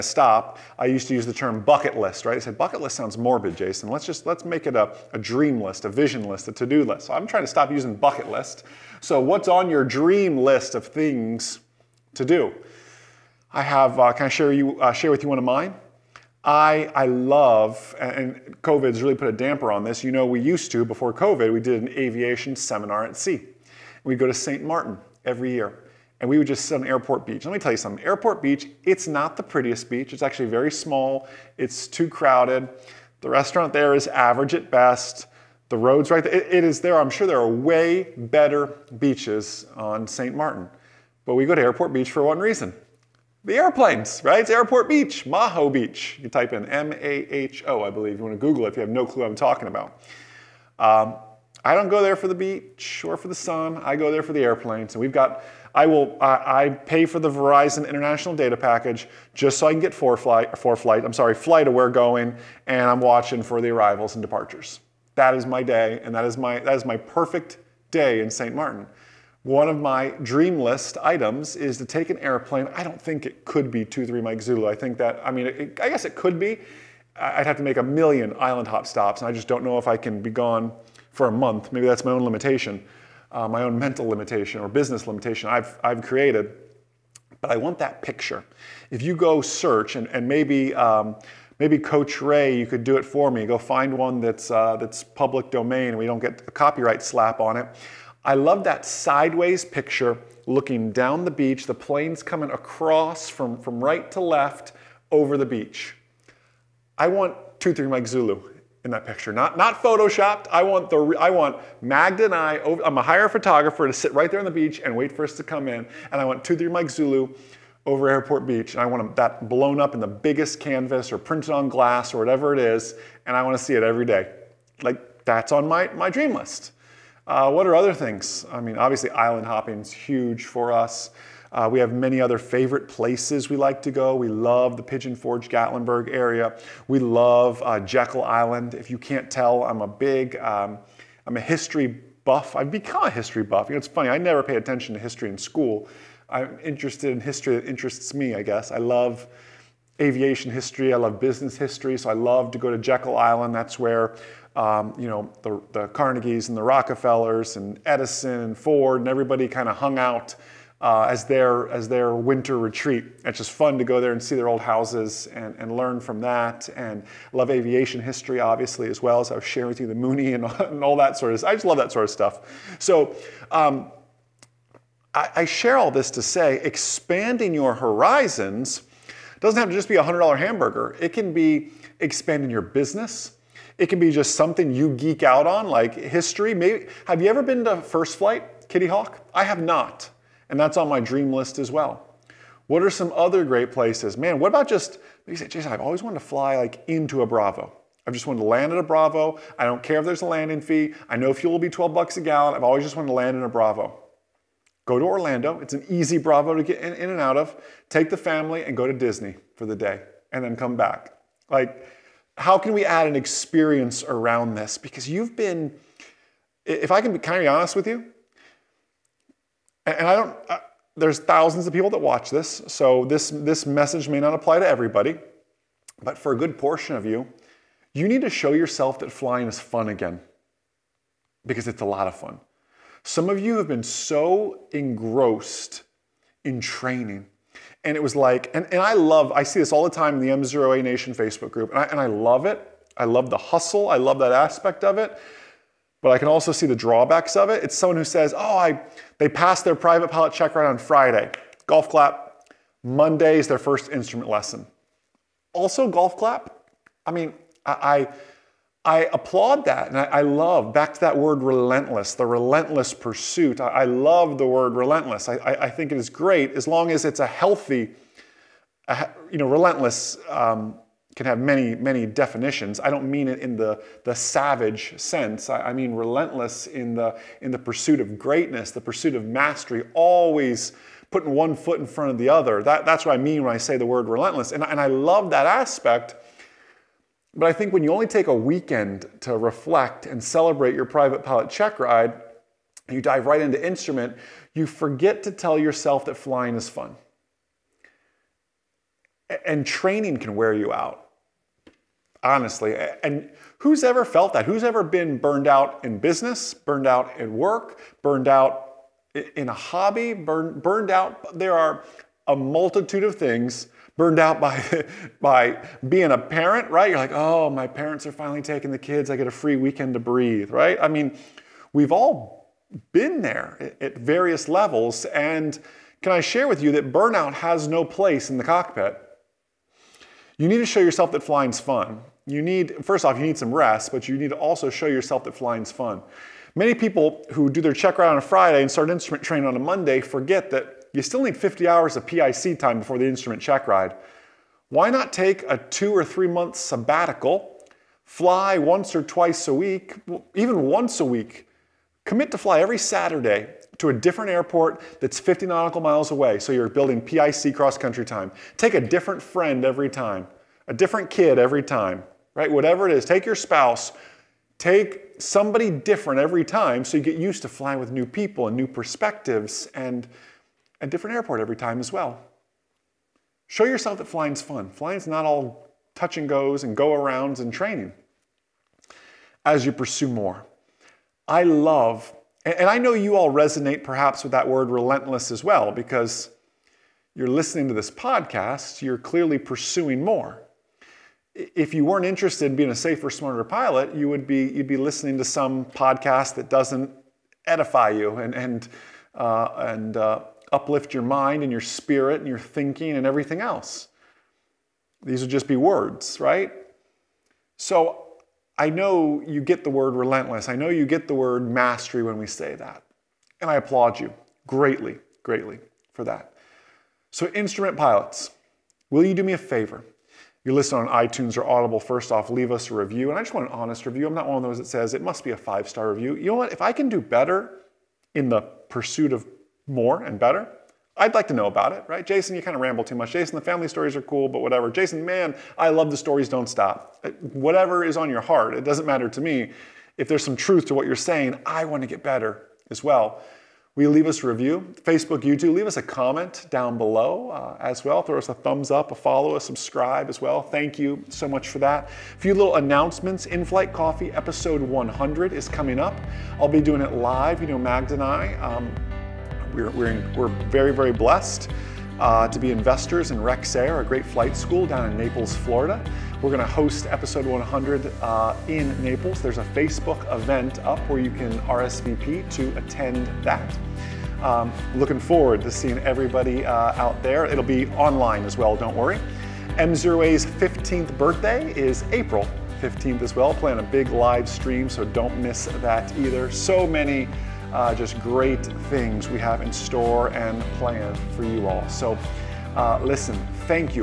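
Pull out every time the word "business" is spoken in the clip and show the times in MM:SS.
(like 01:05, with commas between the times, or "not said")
01:24, 02:31, 03:02, 05:05.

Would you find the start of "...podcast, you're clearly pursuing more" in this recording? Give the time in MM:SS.
06:27.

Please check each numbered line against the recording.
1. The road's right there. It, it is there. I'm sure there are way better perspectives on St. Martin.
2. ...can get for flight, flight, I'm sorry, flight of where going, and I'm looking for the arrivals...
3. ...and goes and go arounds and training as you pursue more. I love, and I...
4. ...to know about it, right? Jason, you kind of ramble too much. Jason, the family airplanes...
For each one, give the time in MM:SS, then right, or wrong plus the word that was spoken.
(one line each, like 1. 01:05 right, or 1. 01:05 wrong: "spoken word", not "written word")
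1. 00:35 wrong: "beaches", not "perspectives"
2. 00:59 wrong: "watching", not "looking"
3. 06:16 right
4. 07:11 wrong: "stories", not "airplanes".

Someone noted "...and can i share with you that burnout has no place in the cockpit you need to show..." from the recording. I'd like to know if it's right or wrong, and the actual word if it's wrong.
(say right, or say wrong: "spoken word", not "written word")
right.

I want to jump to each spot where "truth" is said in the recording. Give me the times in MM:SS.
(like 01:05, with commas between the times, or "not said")
07:20.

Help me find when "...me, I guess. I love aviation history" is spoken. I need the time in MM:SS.
02:28.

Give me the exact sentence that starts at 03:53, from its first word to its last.
Some of you have been so engrossed in training.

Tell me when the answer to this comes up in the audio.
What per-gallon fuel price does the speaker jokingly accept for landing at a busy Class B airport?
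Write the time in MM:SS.
03:21.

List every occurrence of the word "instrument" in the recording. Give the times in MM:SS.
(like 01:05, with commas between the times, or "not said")
04:13, 04:53, 05:38, 05:43, 06:57.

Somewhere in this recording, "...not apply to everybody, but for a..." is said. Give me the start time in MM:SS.
03:44.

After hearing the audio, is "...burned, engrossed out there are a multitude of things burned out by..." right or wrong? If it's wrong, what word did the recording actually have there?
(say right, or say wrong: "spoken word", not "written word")
wrong: "burned", not "engrossed".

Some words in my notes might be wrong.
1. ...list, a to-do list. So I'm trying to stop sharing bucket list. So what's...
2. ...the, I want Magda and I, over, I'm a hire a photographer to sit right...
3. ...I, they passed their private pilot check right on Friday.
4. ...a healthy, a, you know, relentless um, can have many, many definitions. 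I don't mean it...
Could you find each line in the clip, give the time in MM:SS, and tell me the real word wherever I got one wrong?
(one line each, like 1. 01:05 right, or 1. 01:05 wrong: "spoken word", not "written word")
1. 00:06 wrong: "using", not "sharing"
2. 01:50 right
3. 04:08 right
4. 04:27 right.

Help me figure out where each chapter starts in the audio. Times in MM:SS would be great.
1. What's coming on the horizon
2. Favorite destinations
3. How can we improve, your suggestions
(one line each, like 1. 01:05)
1. 07:31
2. 00:56
3. 07:06.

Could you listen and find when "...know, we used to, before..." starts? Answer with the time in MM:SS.
00:20.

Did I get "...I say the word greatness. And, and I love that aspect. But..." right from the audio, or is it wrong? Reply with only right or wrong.
wrong.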